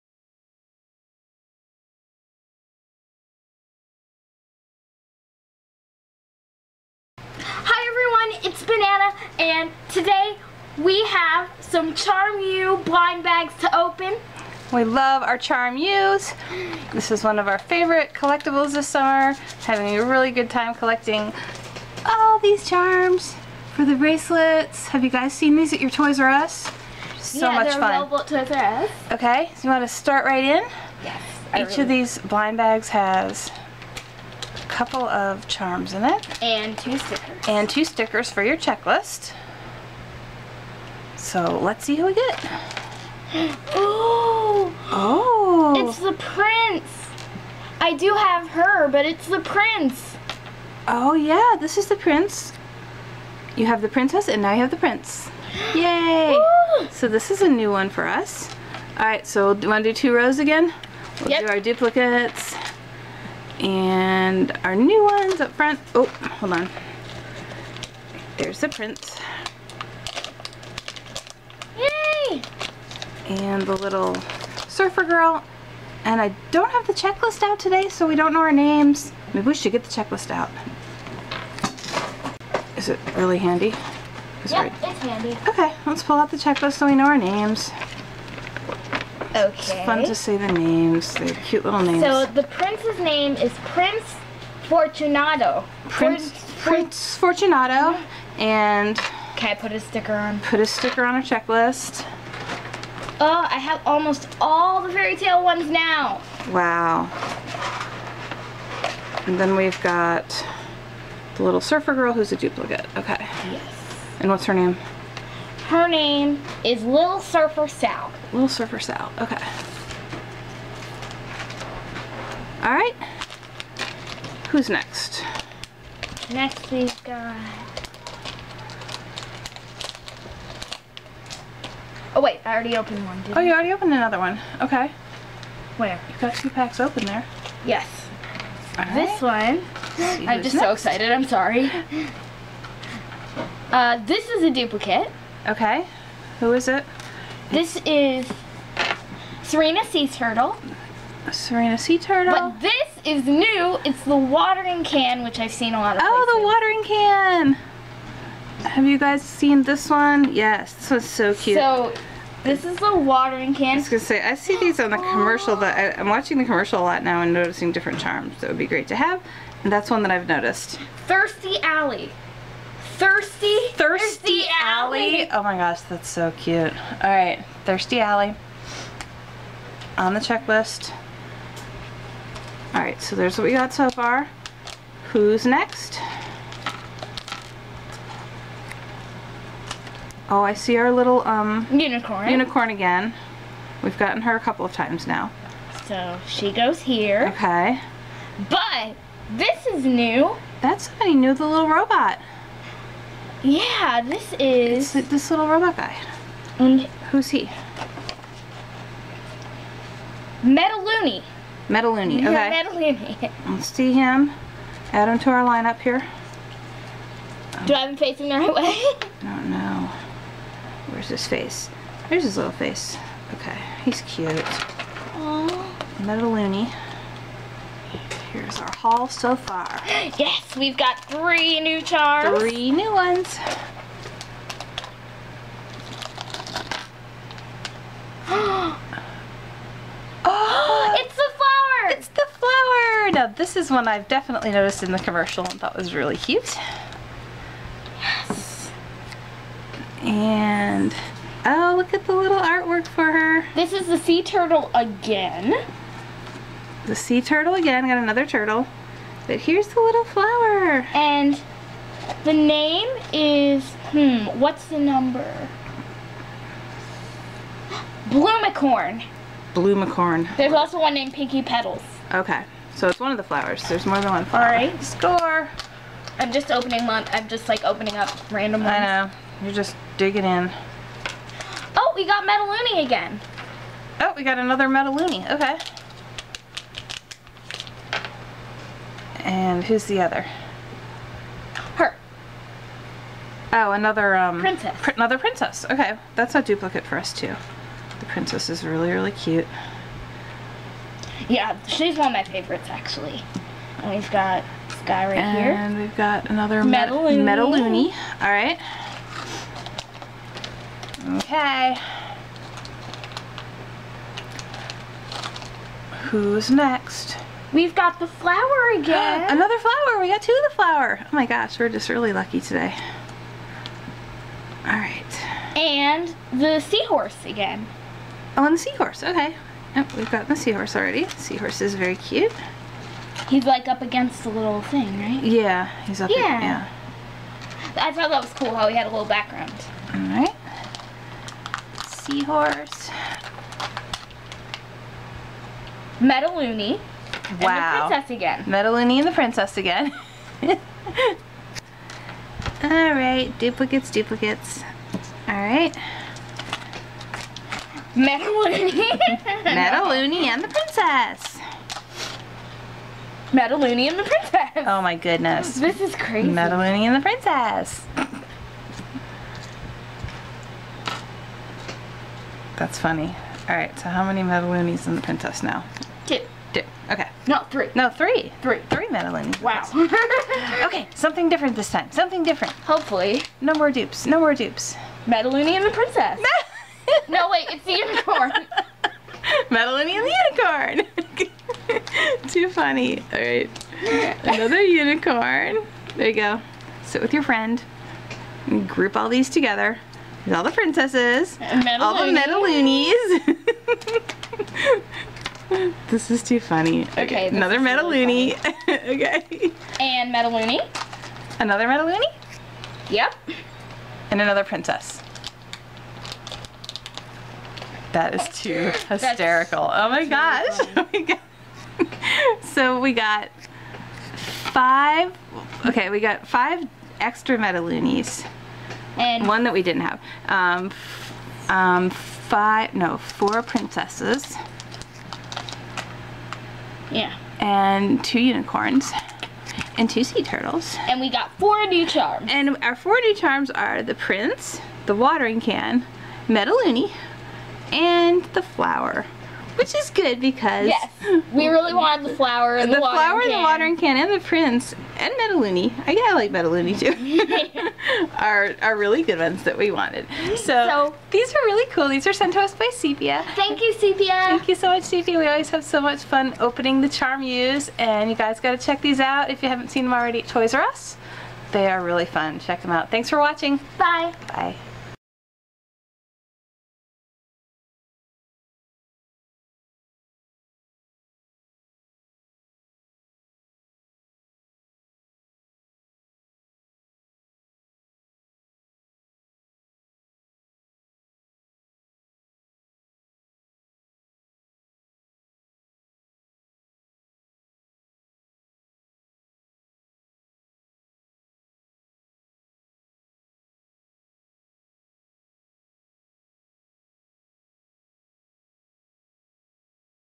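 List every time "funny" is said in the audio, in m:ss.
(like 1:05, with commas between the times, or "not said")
6:12, 6:32, 6:46.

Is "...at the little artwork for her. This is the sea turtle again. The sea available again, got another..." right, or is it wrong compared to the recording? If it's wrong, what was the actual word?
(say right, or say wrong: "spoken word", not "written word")
wrong: "turtle", not "available".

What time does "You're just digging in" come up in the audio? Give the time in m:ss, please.
4:39.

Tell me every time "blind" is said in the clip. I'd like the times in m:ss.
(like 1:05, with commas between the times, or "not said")
0:12, 0:32.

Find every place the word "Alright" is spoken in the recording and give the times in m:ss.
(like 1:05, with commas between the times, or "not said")
0:58, 3:02, 4:34, 5:08, 5:24, 6:13.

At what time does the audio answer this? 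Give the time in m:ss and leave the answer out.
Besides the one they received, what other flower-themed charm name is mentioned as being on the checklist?
4:31.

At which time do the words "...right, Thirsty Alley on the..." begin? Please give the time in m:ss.
2:57.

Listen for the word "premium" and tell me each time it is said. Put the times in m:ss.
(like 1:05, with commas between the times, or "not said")
not said.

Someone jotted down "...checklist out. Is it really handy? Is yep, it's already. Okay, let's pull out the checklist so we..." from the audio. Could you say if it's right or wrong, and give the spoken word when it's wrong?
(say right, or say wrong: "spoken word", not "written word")
wrong: "handy", not "already".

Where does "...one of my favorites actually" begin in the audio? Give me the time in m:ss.
5:01.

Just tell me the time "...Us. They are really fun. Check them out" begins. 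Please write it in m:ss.
7:50.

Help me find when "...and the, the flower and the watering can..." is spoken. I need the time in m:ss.
7:32.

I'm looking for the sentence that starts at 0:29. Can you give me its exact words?
Okay, so you want to start right in?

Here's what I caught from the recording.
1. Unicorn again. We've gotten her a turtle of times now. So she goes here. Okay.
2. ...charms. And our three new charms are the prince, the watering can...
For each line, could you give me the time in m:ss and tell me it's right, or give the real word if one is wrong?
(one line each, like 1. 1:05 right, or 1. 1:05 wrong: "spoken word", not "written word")
1. 3:12 wrong: "couple", not "turtle"
2. 7:21 wrong: "four", not "three".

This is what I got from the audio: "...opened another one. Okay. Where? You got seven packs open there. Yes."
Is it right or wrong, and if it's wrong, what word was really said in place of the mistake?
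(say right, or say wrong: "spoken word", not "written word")
wrong: "two", not "seven".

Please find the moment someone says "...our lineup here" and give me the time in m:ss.
3:35.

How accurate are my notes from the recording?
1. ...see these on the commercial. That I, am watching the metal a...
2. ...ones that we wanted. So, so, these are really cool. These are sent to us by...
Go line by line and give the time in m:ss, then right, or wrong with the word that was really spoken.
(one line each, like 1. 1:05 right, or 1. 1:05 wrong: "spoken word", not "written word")
1. 2:44 wrong: "commercial", not "metal"
2. 7:39 right.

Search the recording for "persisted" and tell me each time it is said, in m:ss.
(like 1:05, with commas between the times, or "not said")
not said.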